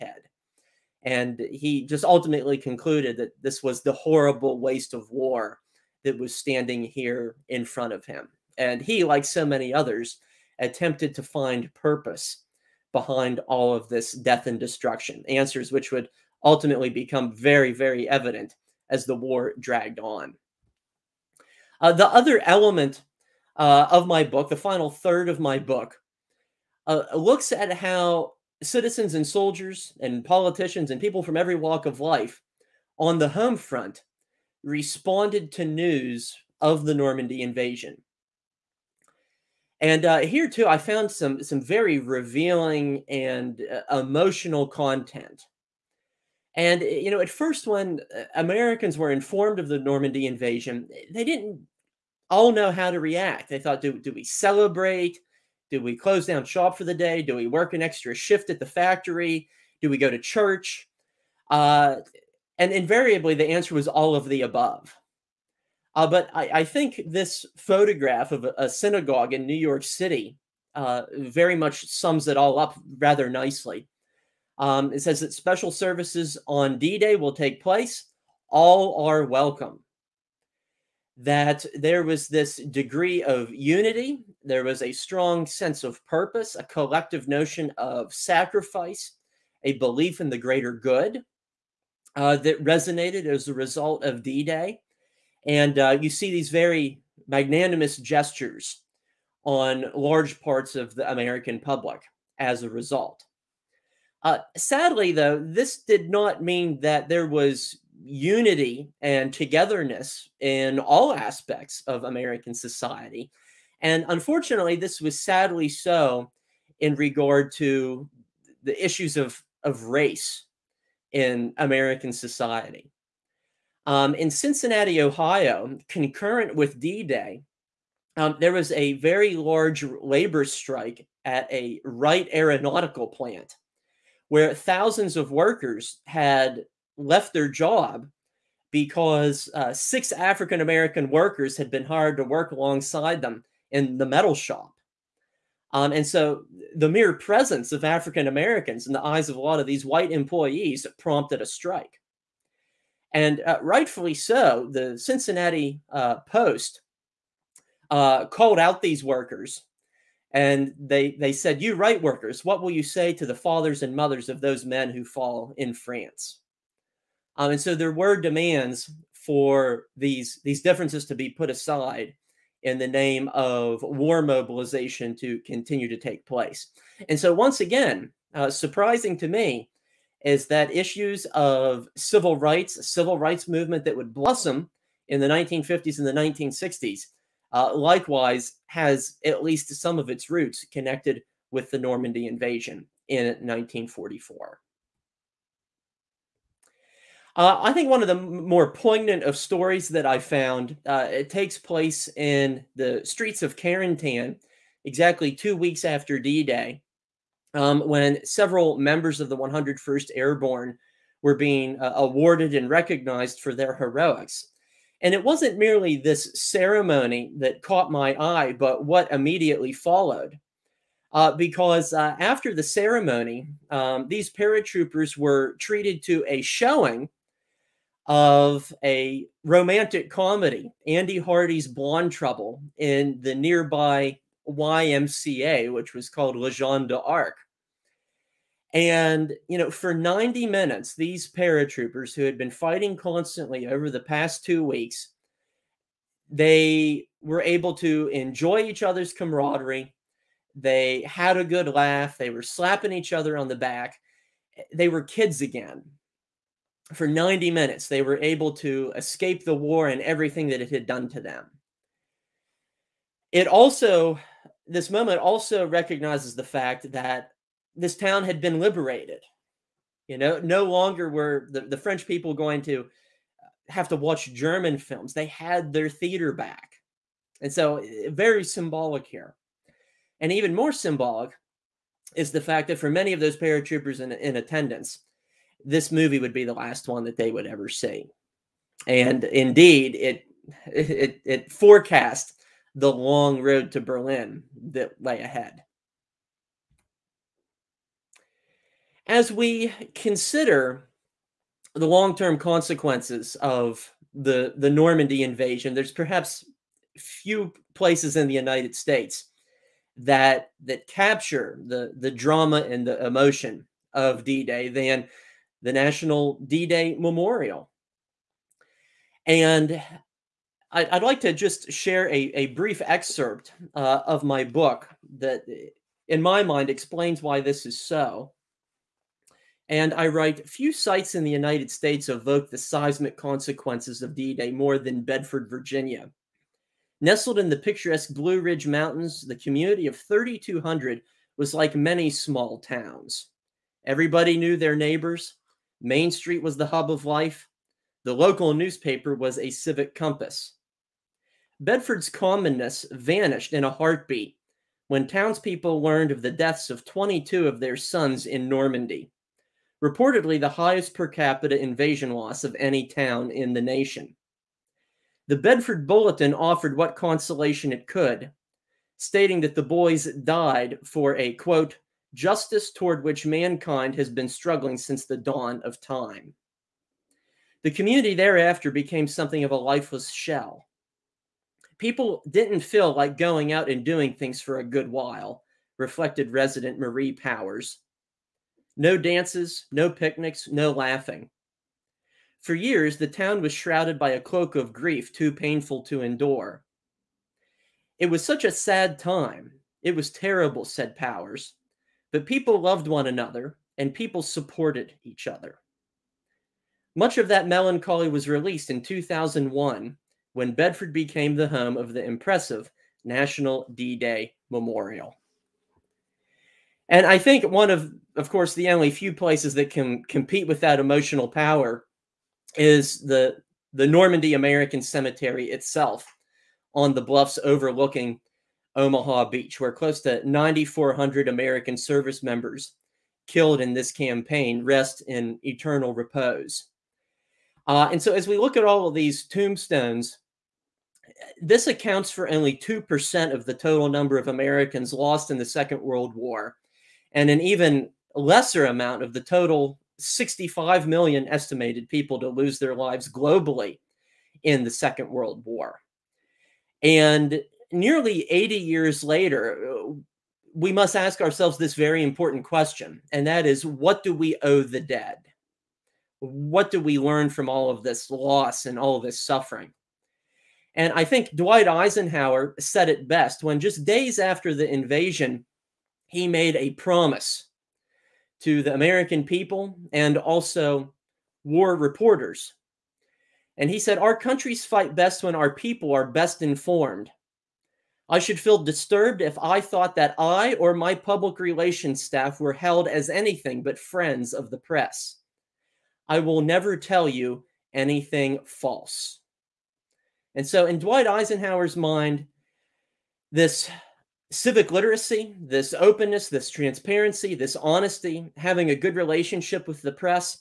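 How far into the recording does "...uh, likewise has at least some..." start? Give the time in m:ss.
3:07.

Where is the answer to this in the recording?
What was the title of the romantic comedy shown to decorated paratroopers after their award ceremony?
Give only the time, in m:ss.
3:50.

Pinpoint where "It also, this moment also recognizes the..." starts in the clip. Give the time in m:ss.
4:23.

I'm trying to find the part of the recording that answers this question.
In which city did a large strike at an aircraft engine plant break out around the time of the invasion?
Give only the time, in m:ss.
2:04.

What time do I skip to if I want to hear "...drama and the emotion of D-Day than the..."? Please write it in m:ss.
5:12.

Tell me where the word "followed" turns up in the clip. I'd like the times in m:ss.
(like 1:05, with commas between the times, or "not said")
3:39.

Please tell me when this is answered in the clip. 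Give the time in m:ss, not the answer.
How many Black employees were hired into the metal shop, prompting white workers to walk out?
2:19.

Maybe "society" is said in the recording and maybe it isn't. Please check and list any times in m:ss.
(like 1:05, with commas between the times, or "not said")
1:52, 2:02.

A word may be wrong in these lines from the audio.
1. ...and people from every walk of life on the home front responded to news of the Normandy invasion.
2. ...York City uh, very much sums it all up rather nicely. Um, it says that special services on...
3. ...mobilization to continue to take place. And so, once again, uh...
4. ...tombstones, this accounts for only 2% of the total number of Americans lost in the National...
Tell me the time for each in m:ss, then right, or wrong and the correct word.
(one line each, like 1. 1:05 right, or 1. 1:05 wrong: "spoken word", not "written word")
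1. 0:30 right
2. 1:09 right
3. 2:54 right
4. 7:19 wrong: "Second", not "National".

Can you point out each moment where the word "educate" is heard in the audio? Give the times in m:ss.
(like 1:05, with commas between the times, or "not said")
not said.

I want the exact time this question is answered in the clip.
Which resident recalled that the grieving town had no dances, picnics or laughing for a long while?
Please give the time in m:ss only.
6:26.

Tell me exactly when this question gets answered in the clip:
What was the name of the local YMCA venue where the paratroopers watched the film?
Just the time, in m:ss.
3:56.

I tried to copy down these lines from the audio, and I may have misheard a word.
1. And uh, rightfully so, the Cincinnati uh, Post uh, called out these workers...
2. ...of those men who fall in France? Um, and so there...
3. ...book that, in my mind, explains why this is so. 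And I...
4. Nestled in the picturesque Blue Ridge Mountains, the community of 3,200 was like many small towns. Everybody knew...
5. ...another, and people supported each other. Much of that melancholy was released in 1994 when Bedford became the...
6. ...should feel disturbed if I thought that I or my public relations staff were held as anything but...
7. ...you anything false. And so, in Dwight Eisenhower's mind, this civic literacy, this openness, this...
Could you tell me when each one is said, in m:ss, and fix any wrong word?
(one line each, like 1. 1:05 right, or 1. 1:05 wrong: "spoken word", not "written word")
1. 2:33 right
2. 2:44 right
3. 5:24 right
4. 5:36 right
5. 6:43 wrong: "2001", not "1994"
6. 8:08 right
7. 8:17 right.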